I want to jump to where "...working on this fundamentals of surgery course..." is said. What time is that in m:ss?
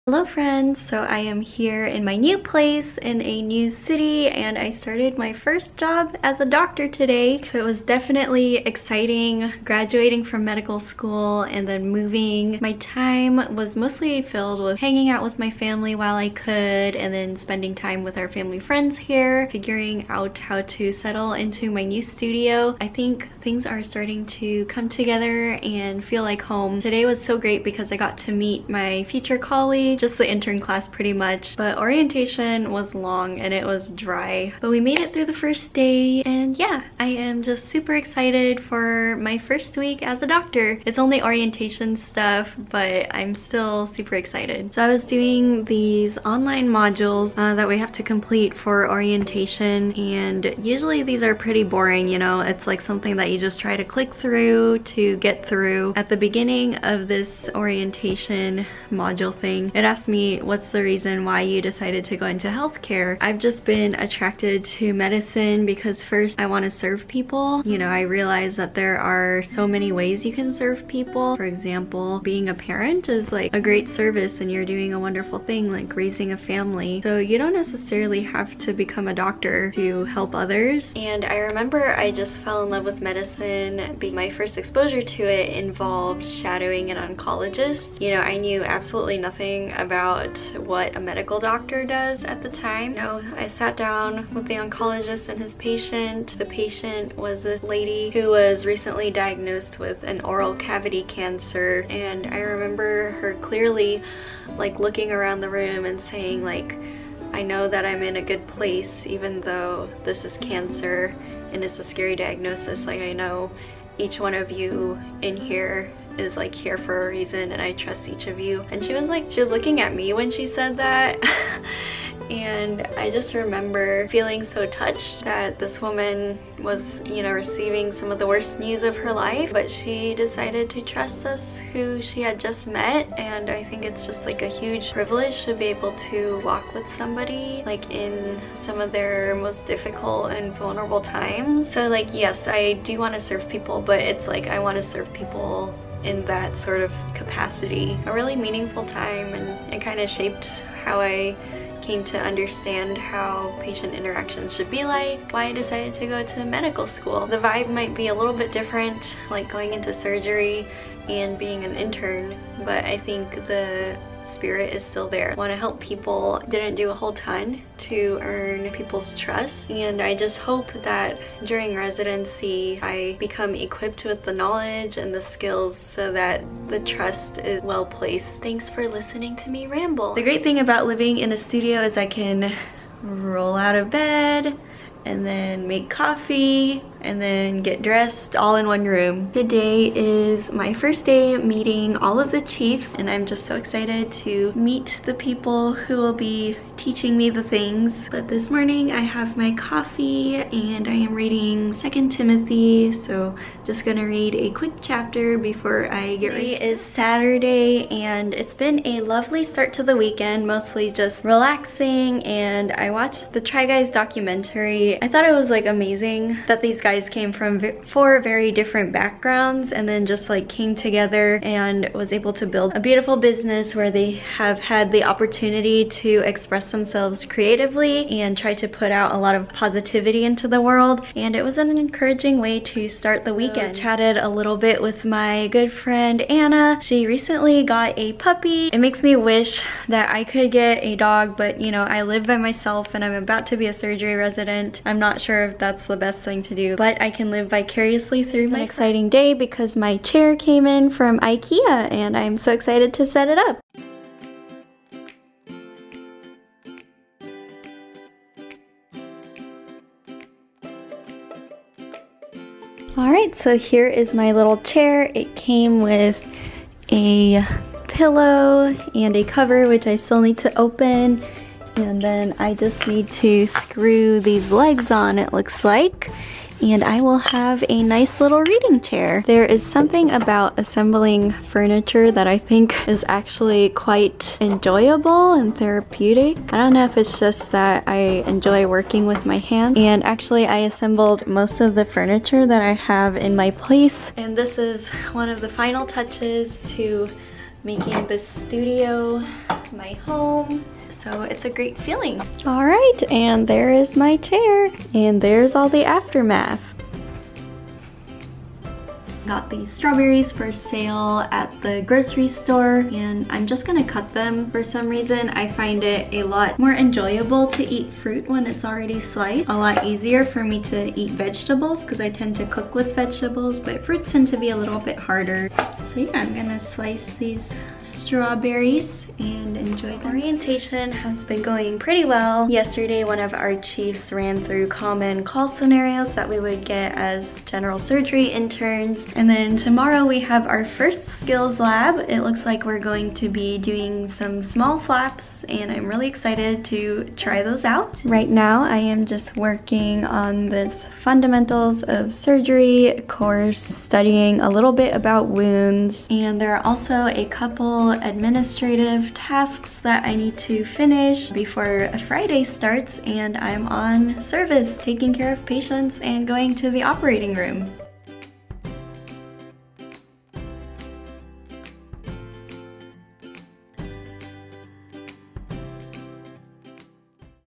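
5:49.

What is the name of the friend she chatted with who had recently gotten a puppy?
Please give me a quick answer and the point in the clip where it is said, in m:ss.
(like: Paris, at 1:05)
Anna, at 3:56.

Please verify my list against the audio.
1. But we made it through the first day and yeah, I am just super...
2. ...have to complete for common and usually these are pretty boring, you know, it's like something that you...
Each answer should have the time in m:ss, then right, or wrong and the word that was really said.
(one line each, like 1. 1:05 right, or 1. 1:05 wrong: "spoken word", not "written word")
1. 0:34 right
2. 0:47 wrong: "orientation", not "common".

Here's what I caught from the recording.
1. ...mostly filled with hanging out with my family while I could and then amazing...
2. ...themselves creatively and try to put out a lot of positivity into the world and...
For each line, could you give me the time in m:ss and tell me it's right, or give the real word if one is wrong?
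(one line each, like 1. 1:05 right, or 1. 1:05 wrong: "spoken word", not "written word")
1. 0:13 wrong: "spending", not "amazing"
2. 3:46 right.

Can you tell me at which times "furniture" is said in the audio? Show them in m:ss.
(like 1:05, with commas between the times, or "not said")
4:41, 4:51.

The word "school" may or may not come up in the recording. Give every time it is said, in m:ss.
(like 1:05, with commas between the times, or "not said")
0:10, 2:36.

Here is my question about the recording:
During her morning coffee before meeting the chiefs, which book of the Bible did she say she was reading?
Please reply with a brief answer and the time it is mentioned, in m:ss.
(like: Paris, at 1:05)
2nd Timothy, at 3:21.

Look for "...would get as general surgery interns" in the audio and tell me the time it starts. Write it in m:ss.
5:36.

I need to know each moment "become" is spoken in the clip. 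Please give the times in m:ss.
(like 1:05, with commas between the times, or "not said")
1:18, 2:53.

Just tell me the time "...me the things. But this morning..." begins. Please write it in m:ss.
3:17.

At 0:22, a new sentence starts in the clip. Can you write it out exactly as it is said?
I think things are starting to come together and feel like home.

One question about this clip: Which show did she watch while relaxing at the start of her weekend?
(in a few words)
Try Guys.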